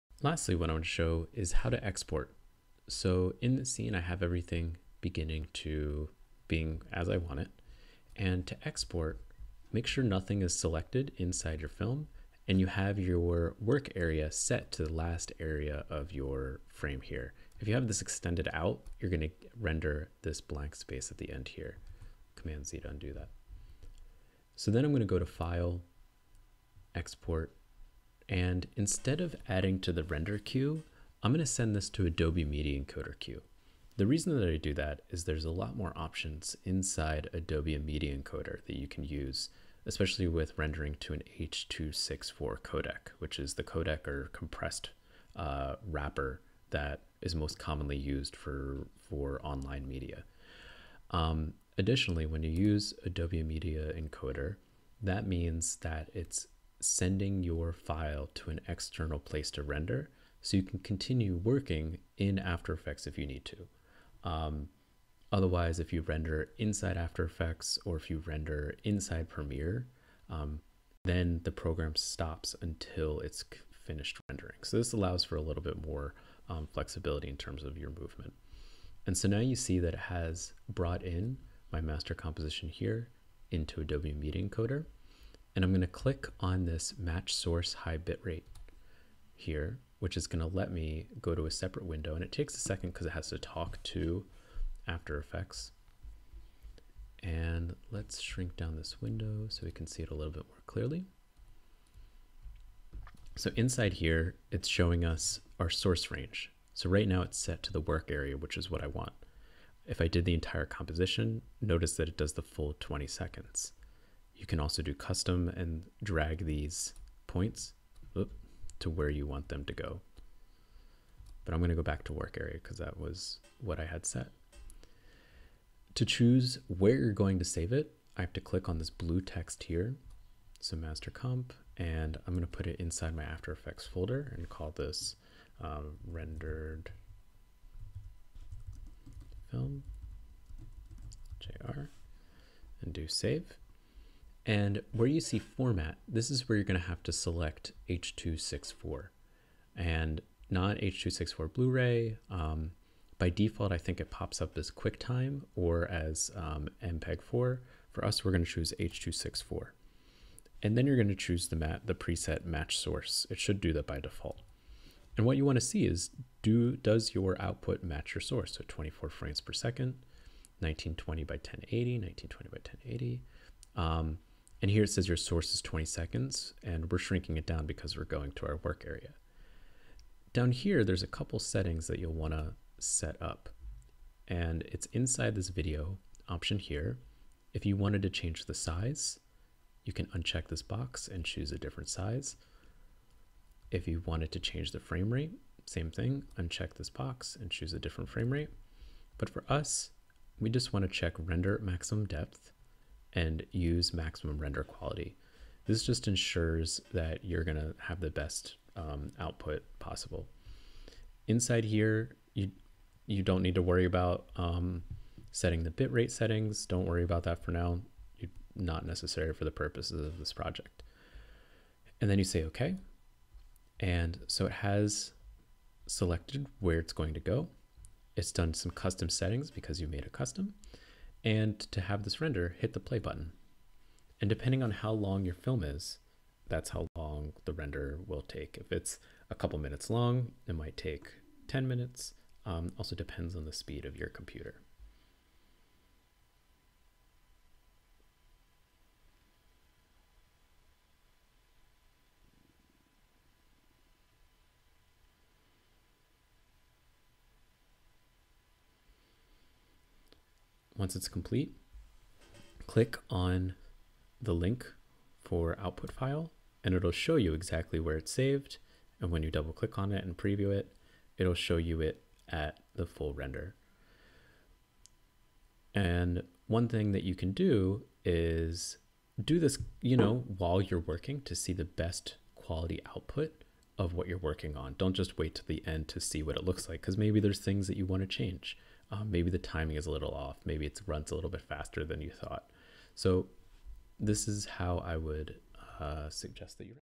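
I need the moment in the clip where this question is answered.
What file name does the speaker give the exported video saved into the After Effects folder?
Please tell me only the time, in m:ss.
2:16.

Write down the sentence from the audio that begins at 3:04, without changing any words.
And it's inside this video option here.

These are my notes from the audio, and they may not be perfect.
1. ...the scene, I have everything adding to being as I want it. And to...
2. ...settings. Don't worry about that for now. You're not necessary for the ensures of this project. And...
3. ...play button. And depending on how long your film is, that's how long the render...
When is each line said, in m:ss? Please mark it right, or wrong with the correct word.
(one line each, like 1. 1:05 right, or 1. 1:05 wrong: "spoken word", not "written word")
1. 0:03 wrong: "beginning", not "adding"
2. 3:36 wrong: "purposes", not "ensures"
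3. 3:52 right.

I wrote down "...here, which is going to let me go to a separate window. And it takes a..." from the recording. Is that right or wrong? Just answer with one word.
right.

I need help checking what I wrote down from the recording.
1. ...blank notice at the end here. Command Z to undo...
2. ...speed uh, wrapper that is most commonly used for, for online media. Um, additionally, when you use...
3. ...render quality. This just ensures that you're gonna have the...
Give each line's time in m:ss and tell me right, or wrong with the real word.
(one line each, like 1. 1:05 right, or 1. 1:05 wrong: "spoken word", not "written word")
1. 0:20 wrong: "space", not "notice"
2. 0:44 wrong: "compressed", not "speed"
3. 3:24 right.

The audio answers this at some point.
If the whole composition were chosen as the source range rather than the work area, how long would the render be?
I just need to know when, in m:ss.
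1:52.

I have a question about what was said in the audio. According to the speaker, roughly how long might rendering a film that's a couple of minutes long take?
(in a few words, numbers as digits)
10 minutes.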